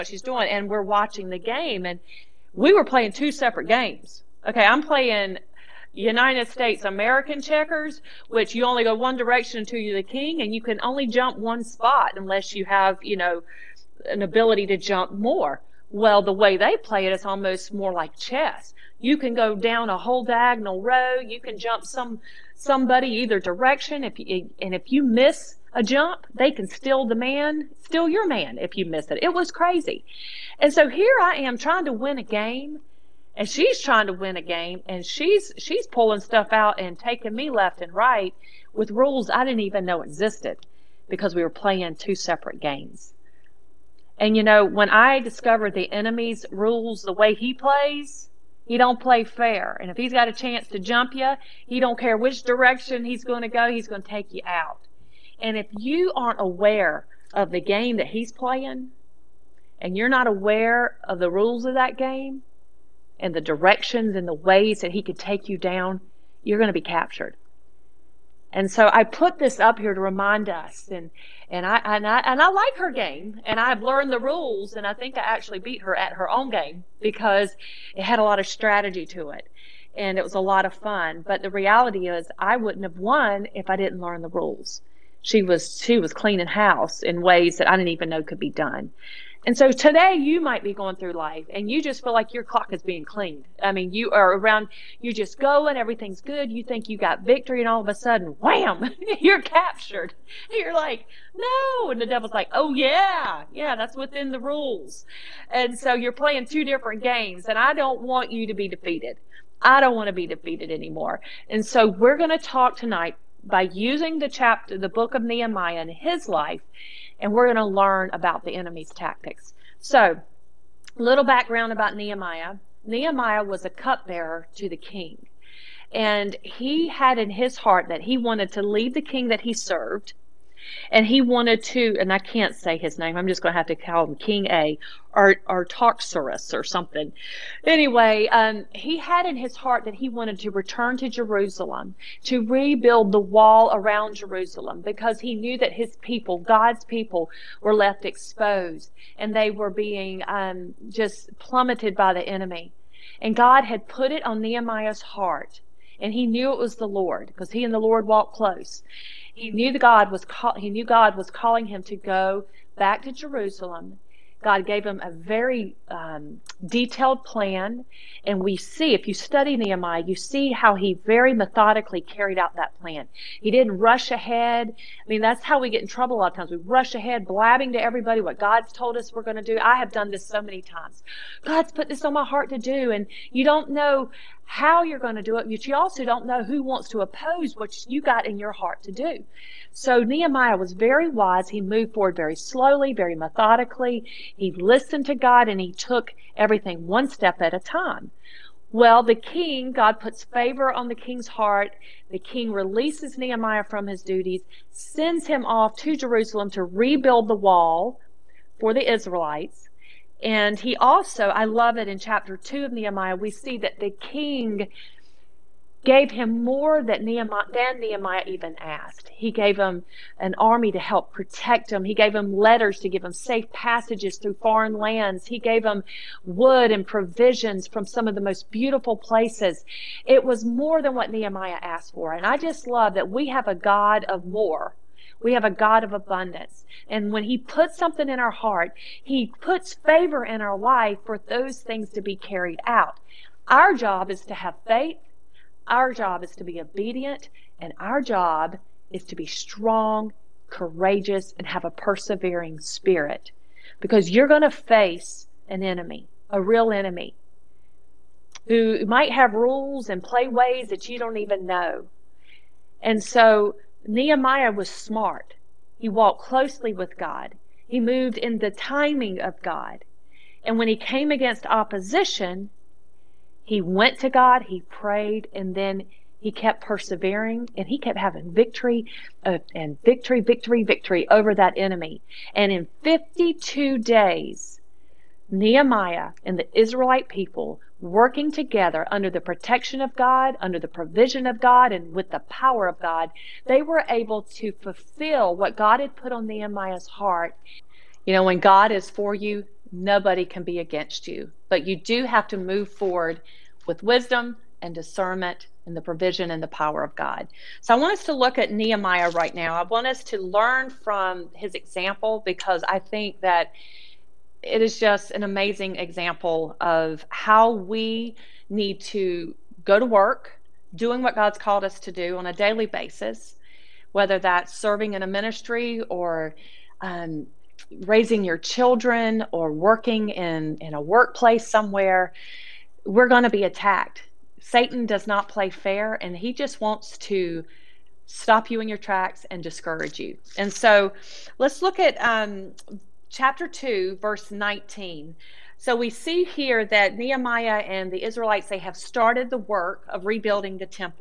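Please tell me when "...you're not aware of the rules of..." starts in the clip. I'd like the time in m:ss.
0:59.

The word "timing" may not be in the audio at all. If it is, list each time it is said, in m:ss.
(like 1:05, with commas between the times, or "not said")
4:28.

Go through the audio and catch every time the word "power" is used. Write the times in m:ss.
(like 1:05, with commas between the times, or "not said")
4:52, 5:06.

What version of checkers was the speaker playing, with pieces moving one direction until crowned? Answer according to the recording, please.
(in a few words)
United States American checkers.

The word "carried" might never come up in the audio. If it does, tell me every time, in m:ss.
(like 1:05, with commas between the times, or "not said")
2:52, 4:02.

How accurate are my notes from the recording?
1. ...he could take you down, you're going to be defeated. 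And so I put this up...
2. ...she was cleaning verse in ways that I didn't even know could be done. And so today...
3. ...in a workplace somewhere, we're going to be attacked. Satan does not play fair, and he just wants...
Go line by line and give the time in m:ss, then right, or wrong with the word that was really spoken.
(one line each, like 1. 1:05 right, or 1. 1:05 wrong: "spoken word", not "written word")
1. 1:04 wrong: "captured", not "defeated"
2. 1:25 wrong: "house", not "verse"
3. 5:30 right.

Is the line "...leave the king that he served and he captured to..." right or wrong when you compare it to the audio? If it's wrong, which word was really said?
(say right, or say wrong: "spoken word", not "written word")
wrong: "wanted", not "captured".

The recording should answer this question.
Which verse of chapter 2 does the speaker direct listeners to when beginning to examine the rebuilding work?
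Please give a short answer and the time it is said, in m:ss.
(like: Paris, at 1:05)
19, at 5:44.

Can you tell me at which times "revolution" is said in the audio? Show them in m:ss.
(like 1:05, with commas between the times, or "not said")
not said.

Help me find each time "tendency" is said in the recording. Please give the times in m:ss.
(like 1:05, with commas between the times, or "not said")
not said.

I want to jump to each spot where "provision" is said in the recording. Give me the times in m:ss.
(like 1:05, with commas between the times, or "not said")
3:46, 4:50, 5:05.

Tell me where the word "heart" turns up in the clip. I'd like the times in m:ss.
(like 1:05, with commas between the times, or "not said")
2:07, 2:19, 2:35, 3:02, 3:08, 3:21, 3:58, 4:56.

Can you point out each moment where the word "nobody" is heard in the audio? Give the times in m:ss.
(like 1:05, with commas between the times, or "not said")
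4:59.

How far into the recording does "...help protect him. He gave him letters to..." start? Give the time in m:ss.
3:40.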